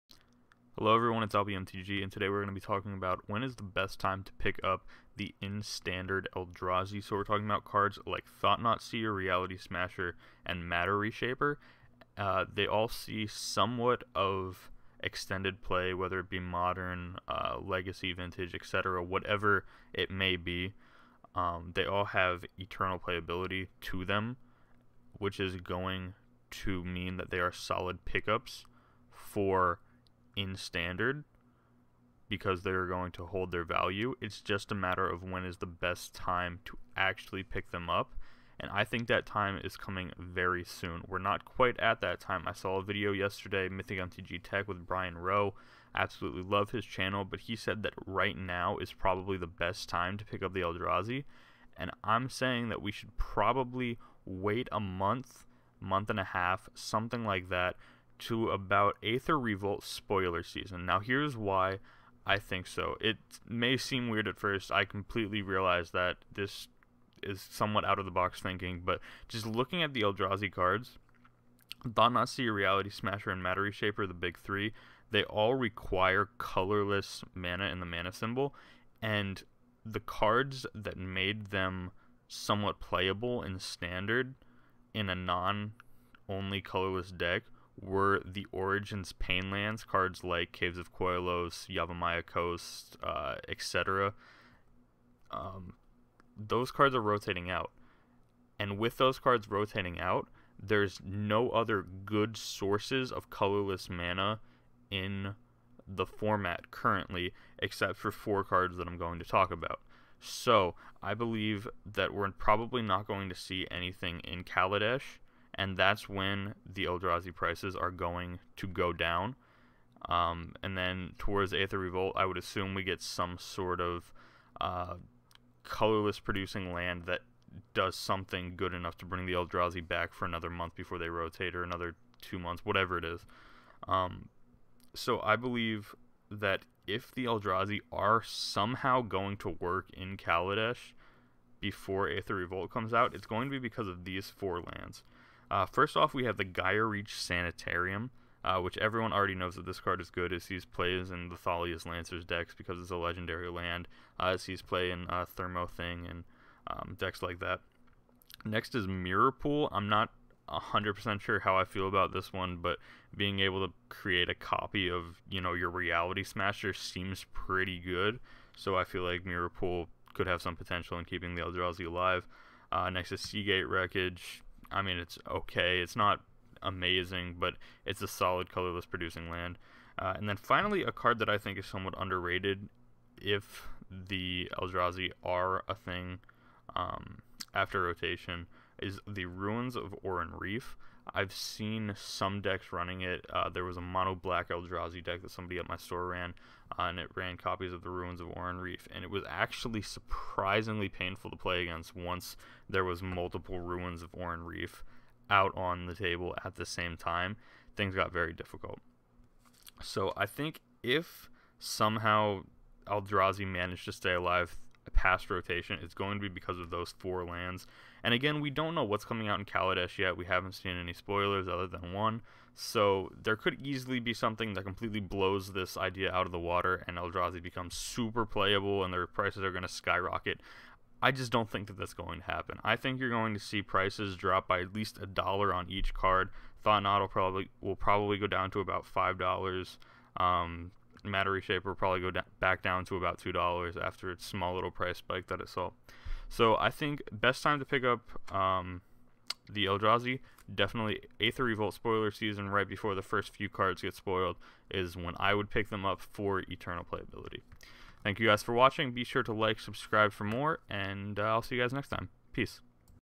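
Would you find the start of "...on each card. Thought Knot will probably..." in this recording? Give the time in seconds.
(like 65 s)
235 s.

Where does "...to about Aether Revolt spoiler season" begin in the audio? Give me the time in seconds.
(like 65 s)
58 s.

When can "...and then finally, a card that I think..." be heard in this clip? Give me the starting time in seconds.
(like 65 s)
180 s.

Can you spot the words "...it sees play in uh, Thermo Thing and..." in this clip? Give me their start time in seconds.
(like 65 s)
154 s.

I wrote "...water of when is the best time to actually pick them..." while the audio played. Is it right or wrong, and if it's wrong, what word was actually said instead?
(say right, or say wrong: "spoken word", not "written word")
wrong: "matter", not "water".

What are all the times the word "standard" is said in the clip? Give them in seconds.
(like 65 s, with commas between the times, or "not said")
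5 s, 30 s, 83 s.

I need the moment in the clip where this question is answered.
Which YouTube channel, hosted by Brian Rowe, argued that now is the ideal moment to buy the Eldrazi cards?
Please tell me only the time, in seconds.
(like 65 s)
43 s.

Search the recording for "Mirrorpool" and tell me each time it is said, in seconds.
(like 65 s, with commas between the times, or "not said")
158 s, 169 s.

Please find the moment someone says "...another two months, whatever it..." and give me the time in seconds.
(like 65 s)
131 s.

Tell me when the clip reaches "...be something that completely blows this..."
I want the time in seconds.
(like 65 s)
223 s.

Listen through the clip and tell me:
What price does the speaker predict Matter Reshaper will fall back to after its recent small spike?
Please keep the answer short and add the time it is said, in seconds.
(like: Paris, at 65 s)
$2, at 243 s.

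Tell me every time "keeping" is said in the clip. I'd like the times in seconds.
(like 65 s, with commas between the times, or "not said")
171 s.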